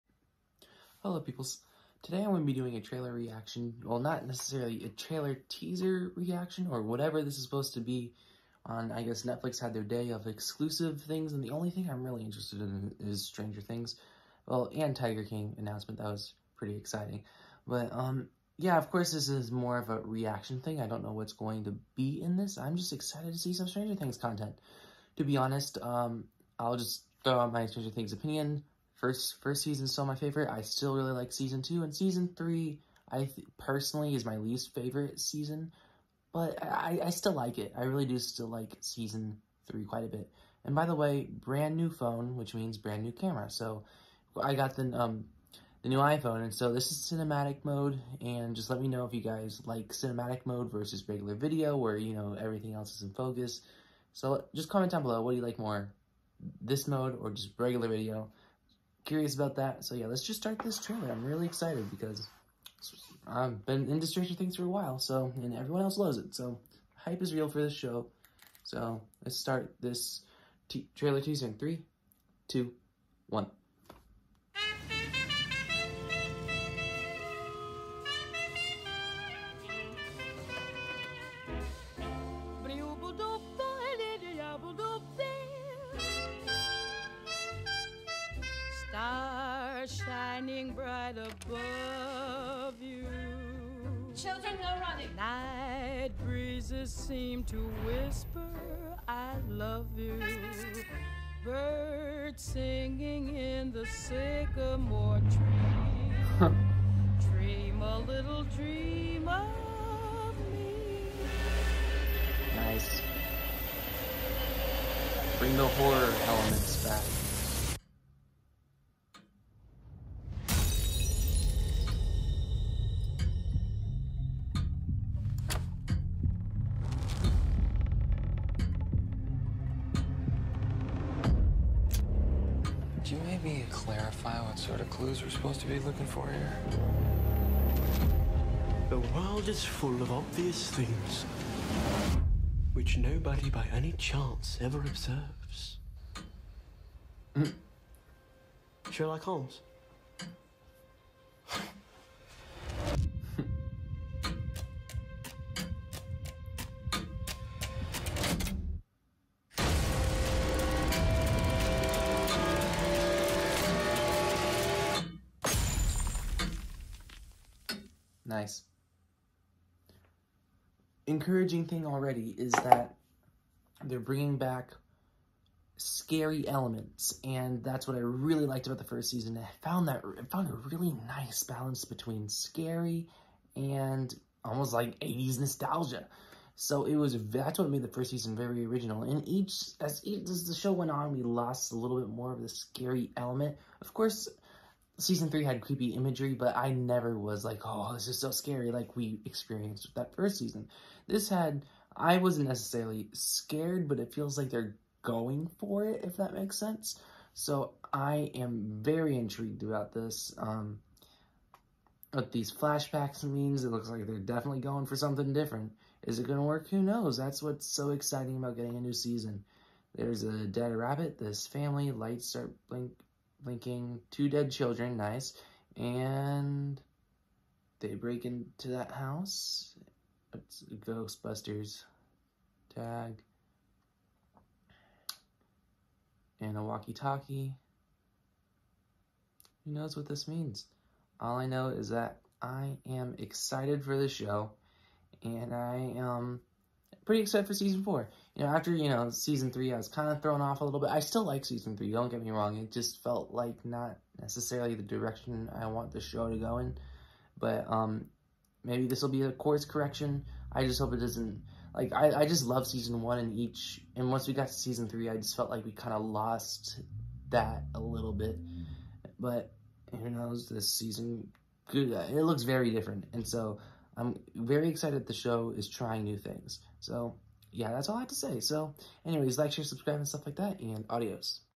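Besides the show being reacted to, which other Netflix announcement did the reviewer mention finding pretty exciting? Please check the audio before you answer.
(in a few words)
Tiger King.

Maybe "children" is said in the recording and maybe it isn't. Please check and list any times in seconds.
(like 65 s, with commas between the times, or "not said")
94 s, 224 s.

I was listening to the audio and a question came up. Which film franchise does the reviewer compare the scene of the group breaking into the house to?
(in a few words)
Ghostbusters.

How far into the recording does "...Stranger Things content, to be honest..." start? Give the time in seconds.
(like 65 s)
23 s.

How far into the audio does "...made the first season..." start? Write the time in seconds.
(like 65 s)
187 s.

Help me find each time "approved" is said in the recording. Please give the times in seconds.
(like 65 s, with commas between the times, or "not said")
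not said.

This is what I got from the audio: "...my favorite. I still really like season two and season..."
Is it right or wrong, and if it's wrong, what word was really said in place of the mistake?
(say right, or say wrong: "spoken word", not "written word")
right.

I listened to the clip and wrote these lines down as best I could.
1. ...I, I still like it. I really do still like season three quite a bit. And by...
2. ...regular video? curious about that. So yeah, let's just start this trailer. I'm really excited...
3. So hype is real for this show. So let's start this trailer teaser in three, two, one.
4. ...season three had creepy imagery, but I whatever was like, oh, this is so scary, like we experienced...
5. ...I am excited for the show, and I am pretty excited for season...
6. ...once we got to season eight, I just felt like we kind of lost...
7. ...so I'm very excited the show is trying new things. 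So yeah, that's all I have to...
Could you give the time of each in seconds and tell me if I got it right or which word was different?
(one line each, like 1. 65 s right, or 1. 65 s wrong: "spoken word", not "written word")
1. 36 s right
2. 57 s right
3. 66 s right
4. 194 s wrong: "never", not "whatever"
5. 242 s right
6. 264 s wrong: "three", not "eight"
7. 273 s right.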